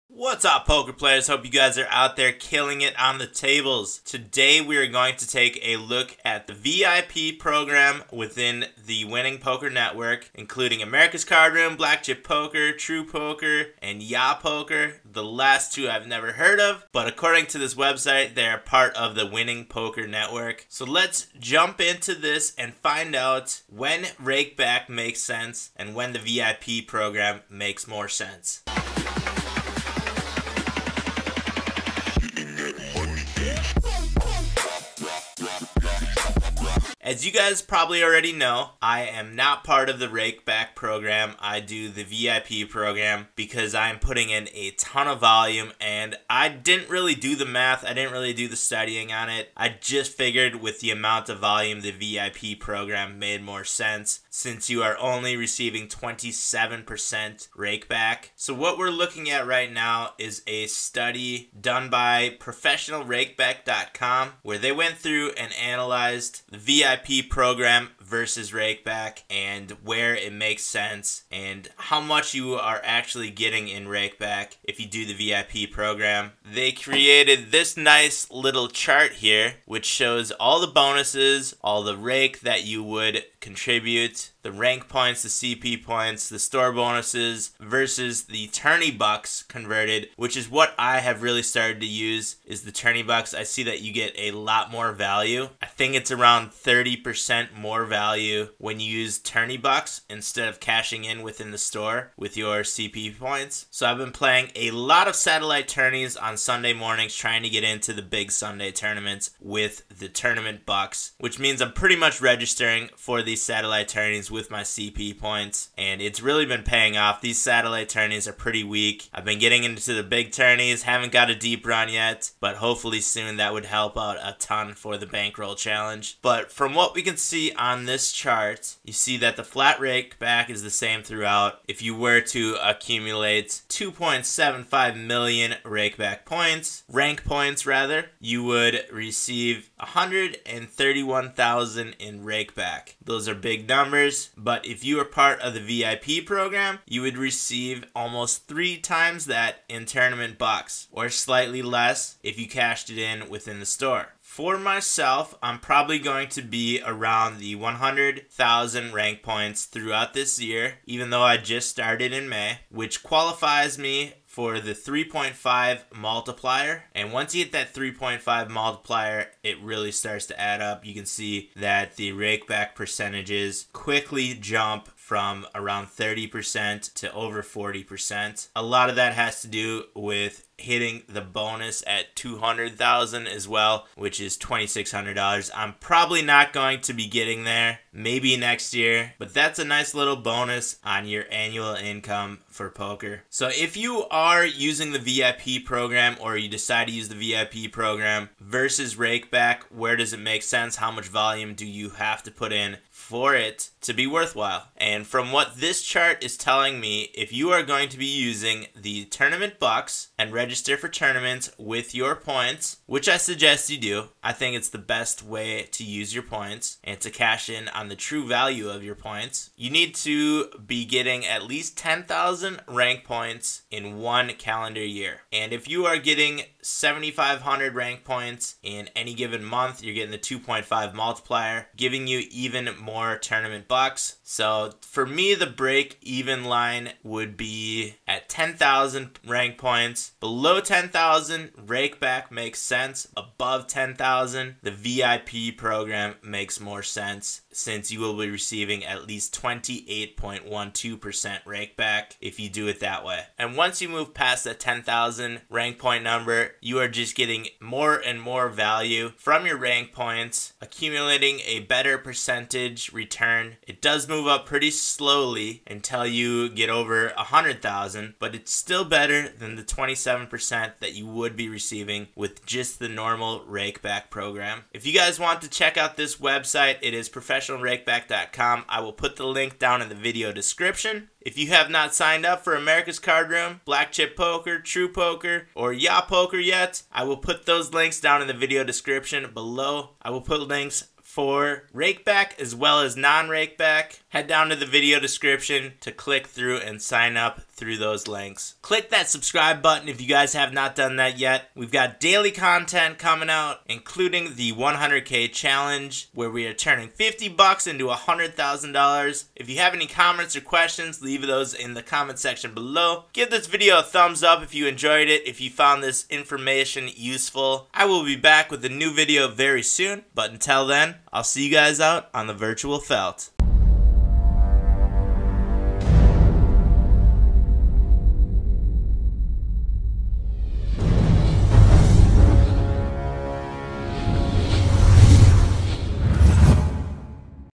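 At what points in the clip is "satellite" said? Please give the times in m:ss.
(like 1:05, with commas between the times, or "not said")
1:45, 1:53, 1:57.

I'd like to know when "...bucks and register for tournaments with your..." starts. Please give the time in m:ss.
3:29.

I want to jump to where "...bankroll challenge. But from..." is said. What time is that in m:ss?
2:05.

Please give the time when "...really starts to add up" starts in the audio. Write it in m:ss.
2:49.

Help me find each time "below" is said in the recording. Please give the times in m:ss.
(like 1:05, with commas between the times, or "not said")
4:00, 4:49, 5:12.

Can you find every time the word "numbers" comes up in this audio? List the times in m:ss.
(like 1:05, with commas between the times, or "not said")
2:23, 4:16.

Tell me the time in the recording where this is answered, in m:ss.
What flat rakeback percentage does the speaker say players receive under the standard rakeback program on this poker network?
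0:55.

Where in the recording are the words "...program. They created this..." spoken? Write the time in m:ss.
1:15.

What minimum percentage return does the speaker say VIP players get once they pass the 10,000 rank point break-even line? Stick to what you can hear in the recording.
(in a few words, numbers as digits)
28.12%.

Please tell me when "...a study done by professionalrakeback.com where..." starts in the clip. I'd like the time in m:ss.
1:00.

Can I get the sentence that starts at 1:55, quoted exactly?
And it's really been paying off.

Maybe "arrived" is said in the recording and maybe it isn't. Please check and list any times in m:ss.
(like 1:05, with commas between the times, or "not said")
not said.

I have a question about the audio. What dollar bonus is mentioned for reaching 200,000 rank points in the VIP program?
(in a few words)
$2,600.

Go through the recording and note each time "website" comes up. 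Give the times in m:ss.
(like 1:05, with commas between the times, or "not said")
0:17, 4:36.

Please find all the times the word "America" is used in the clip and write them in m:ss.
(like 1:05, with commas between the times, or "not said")
0:10, 4:42.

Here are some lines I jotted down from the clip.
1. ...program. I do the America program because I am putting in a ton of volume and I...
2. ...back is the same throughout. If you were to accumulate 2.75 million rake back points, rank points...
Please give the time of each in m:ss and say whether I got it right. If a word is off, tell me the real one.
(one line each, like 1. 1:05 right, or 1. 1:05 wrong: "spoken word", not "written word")
1. 0:40 wrong: "VIP", not "America"
2. 2:10 right.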